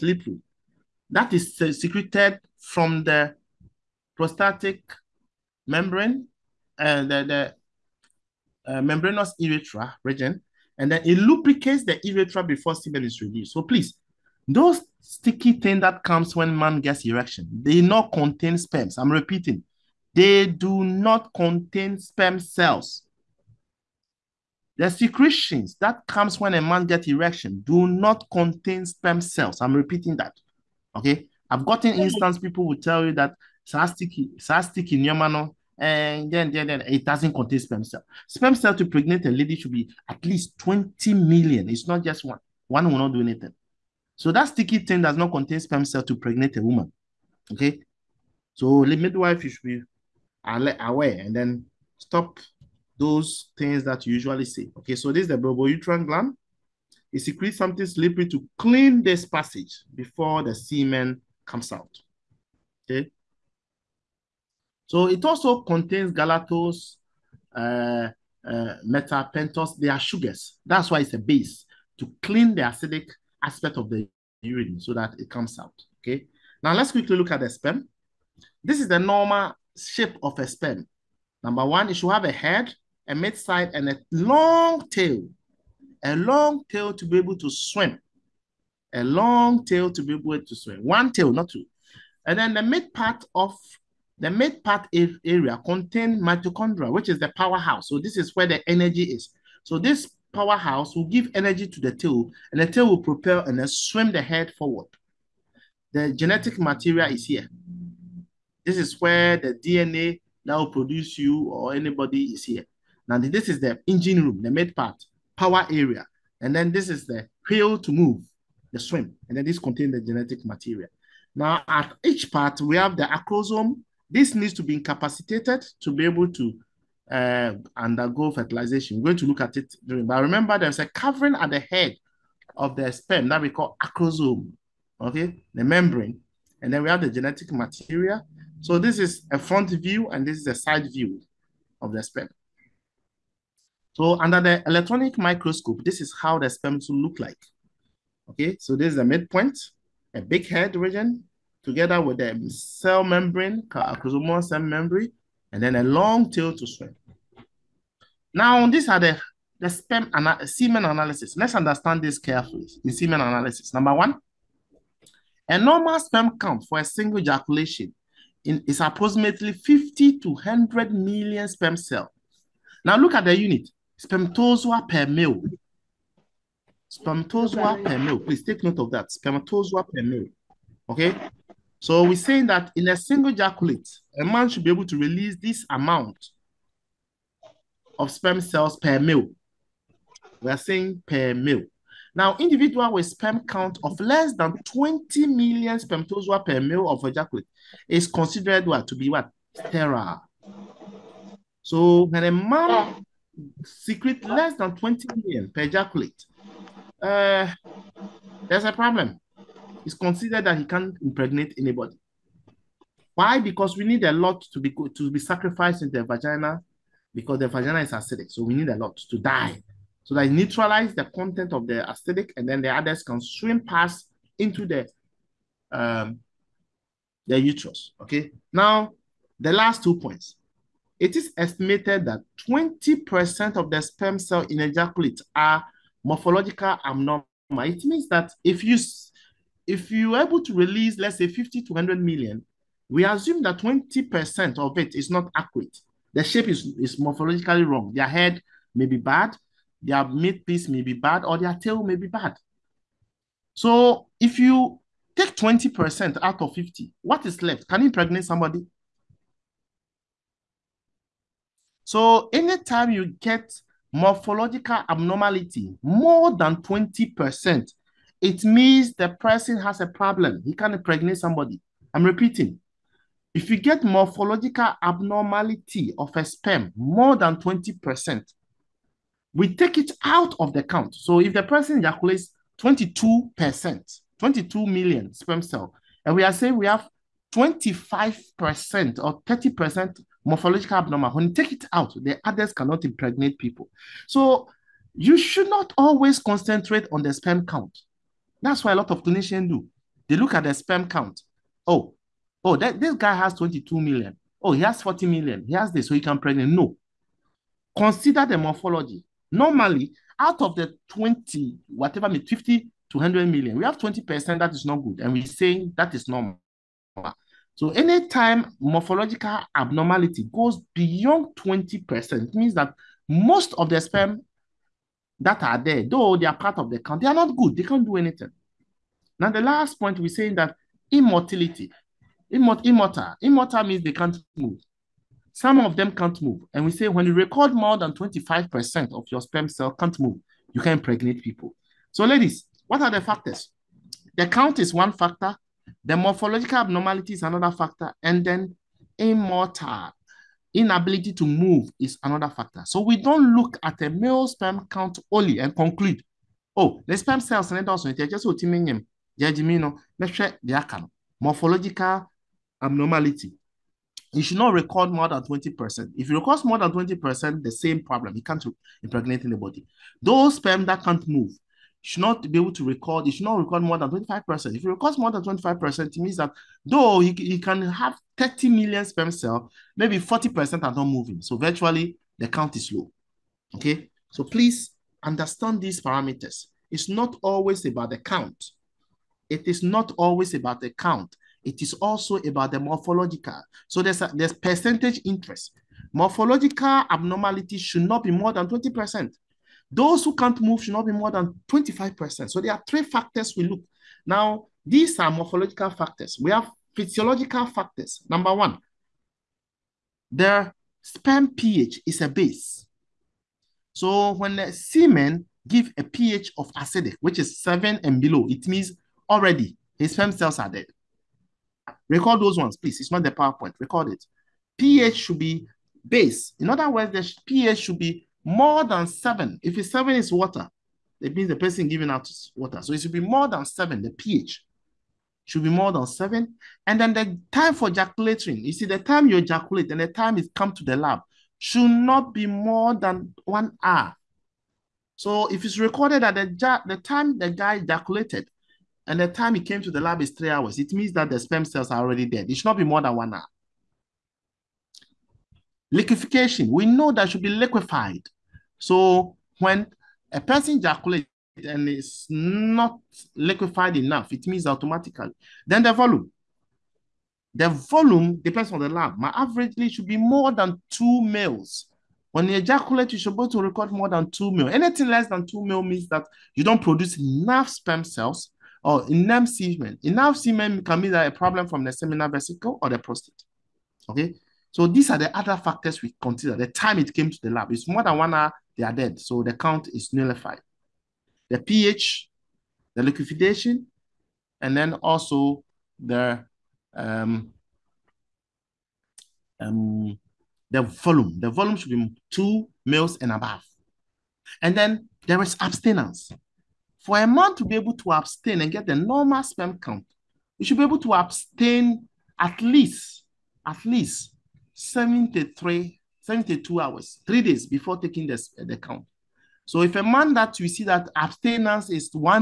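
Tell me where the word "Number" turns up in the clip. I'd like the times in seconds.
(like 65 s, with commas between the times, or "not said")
81 s, 163 s, 408 s.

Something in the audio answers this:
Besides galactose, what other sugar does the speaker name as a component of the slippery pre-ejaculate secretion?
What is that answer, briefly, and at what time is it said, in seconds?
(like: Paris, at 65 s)
methylpentose, at 68 s.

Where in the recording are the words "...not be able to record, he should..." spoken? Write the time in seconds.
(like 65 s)
372 s.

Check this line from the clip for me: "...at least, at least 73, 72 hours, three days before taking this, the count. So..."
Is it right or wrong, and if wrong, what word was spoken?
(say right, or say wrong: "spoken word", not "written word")
right.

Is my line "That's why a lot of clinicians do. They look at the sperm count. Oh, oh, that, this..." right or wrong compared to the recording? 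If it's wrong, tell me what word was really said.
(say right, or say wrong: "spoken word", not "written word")
right.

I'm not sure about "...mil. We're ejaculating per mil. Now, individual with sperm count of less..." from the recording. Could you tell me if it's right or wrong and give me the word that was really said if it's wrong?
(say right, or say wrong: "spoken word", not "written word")
wrong: "saying", not "ejaculating".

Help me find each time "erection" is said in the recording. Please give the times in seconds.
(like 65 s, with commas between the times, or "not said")
17 s, 27 s.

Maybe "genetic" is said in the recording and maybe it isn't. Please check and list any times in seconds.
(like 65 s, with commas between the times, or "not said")
106 s, 120 s, 137 s.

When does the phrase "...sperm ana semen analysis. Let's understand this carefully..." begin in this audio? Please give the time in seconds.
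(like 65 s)
159 s.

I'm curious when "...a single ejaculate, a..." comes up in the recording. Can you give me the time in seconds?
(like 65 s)
182 s.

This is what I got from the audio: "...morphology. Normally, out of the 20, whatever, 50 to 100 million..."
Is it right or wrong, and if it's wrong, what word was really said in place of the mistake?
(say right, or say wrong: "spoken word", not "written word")
right.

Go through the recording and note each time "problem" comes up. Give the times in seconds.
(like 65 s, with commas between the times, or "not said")
208 s, 269 s, 367 s, 481 s.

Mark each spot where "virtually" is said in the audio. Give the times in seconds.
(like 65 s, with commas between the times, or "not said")
381 s.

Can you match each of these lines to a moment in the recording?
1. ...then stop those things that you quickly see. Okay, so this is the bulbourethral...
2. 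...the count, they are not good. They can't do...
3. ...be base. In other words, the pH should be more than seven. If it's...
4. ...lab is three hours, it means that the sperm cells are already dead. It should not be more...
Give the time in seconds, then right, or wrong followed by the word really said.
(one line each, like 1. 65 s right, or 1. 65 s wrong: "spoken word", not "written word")
1. 51 s wrong: "usually", not "quickly"
2. 326 s right
3. 425 s right
4. 449 s right.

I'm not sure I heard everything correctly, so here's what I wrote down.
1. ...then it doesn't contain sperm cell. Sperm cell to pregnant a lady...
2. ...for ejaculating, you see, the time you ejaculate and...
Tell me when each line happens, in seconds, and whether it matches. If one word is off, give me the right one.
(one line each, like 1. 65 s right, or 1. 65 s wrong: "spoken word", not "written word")
1. 36 s right
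2. 437 s right.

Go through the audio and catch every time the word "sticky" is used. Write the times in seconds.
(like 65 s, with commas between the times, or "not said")
15 s, 44 s.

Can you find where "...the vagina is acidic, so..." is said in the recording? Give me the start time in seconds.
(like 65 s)
217 s.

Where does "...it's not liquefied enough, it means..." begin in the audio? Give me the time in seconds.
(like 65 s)
461 s.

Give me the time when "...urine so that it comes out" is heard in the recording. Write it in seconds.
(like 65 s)
74 s.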